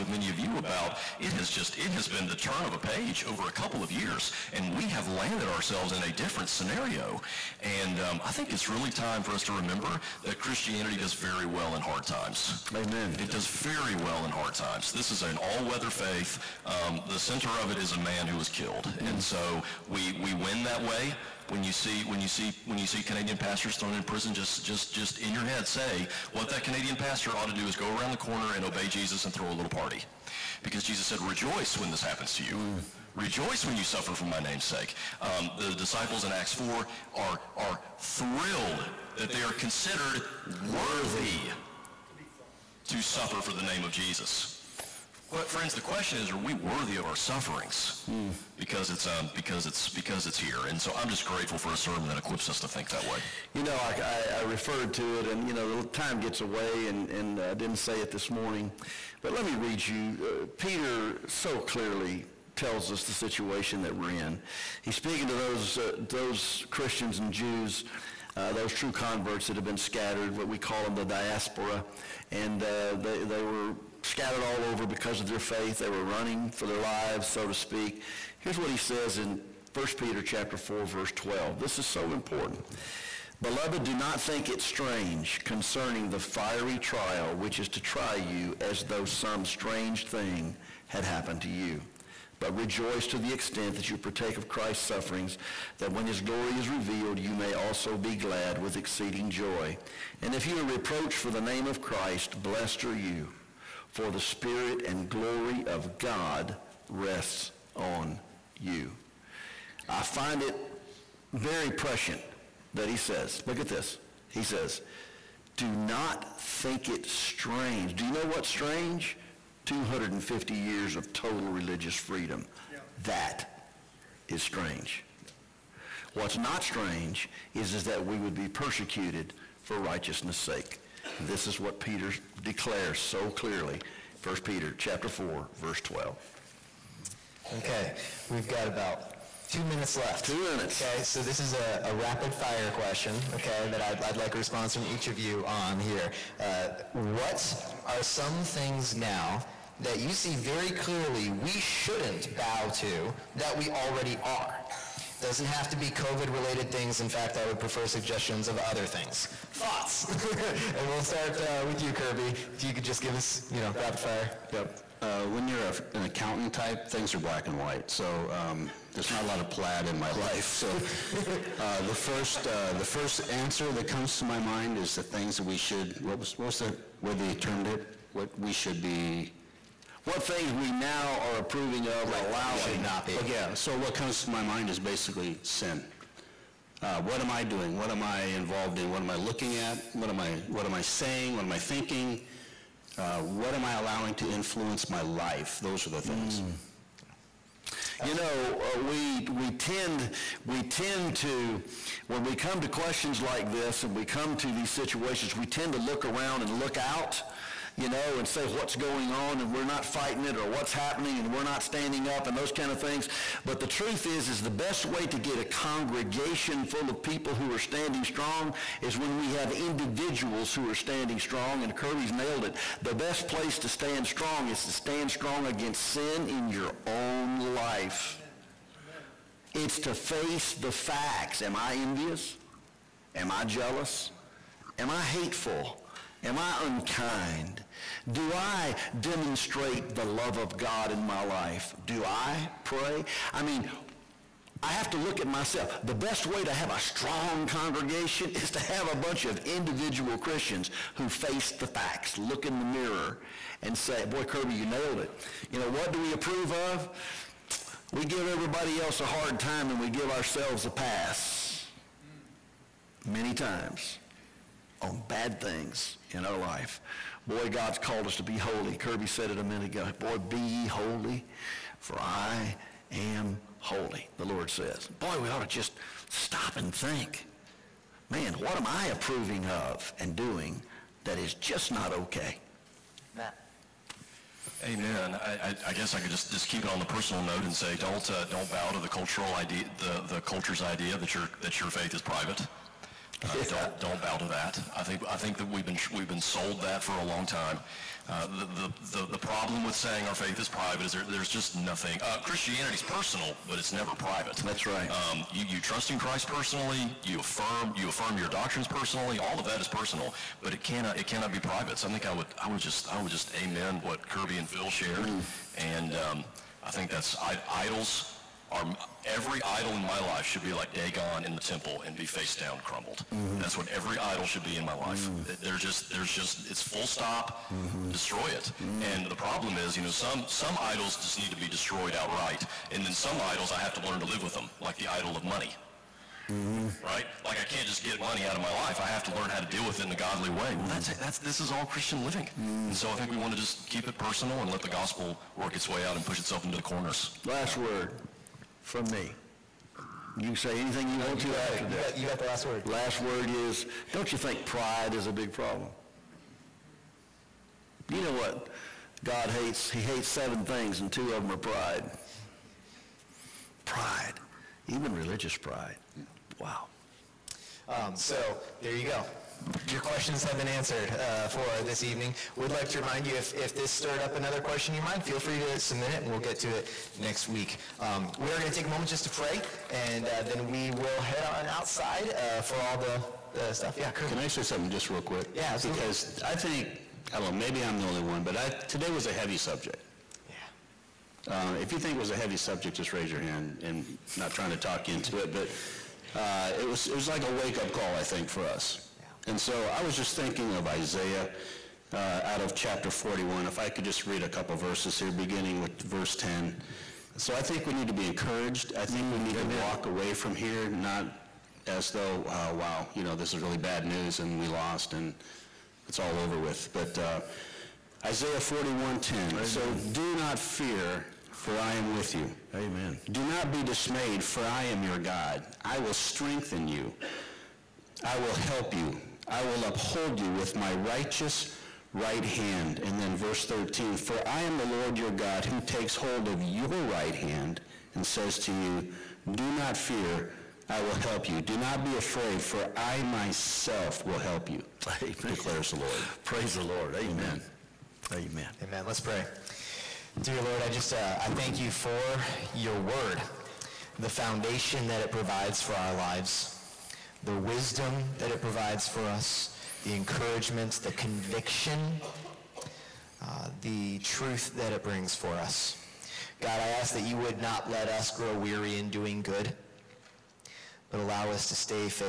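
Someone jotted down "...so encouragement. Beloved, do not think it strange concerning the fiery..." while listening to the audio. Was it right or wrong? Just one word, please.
wrong.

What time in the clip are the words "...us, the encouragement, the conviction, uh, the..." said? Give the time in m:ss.
7:39.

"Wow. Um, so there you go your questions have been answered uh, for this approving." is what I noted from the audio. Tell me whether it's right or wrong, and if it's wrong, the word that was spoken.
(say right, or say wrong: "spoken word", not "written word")
wrong: "evening", not "approving".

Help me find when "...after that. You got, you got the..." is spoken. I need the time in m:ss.
5:51.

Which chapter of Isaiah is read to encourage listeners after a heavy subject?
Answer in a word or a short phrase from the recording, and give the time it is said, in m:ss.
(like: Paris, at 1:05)
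41, at 6:42.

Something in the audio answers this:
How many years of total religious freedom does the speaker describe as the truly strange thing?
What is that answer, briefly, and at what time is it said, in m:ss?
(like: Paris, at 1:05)
250, at 1:59.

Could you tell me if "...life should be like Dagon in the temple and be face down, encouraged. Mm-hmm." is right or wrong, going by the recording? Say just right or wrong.
wrong.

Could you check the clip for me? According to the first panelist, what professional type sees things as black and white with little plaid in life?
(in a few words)
An accountant.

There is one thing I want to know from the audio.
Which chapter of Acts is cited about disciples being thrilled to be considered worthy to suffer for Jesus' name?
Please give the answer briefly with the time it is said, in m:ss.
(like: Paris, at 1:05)
4, at 0:36.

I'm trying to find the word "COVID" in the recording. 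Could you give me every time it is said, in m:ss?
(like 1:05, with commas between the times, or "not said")
2:35.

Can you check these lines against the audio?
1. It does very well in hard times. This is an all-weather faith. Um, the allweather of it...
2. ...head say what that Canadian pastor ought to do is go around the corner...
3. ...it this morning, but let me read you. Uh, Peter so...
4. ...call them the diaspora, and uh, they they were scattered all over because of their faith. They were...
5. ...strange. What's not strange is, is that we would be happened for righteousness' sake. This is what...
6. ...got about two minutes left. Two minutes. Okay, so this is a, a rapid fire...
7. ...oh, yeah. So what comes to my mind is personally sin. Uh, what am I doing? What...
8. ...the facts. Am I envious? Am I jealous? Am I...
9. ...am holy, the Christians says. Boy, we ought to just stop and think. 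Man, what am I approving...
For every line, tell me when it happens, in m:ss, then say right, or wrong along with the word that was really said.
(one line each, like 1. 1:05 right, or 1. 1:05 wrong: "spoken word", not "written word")
1. 0:13 wrong: "center", not "allweather"
2. 0:25 right
3. 0:58 right
4. 1:10 right
5. 2:04 wrong: "persecuted", not "happened"
6. 2:18 right
7. 3:03 wrong: "basically", not "personally"
8. 3:50 right
9. 4:32 wrong: "Lord", not "Christians".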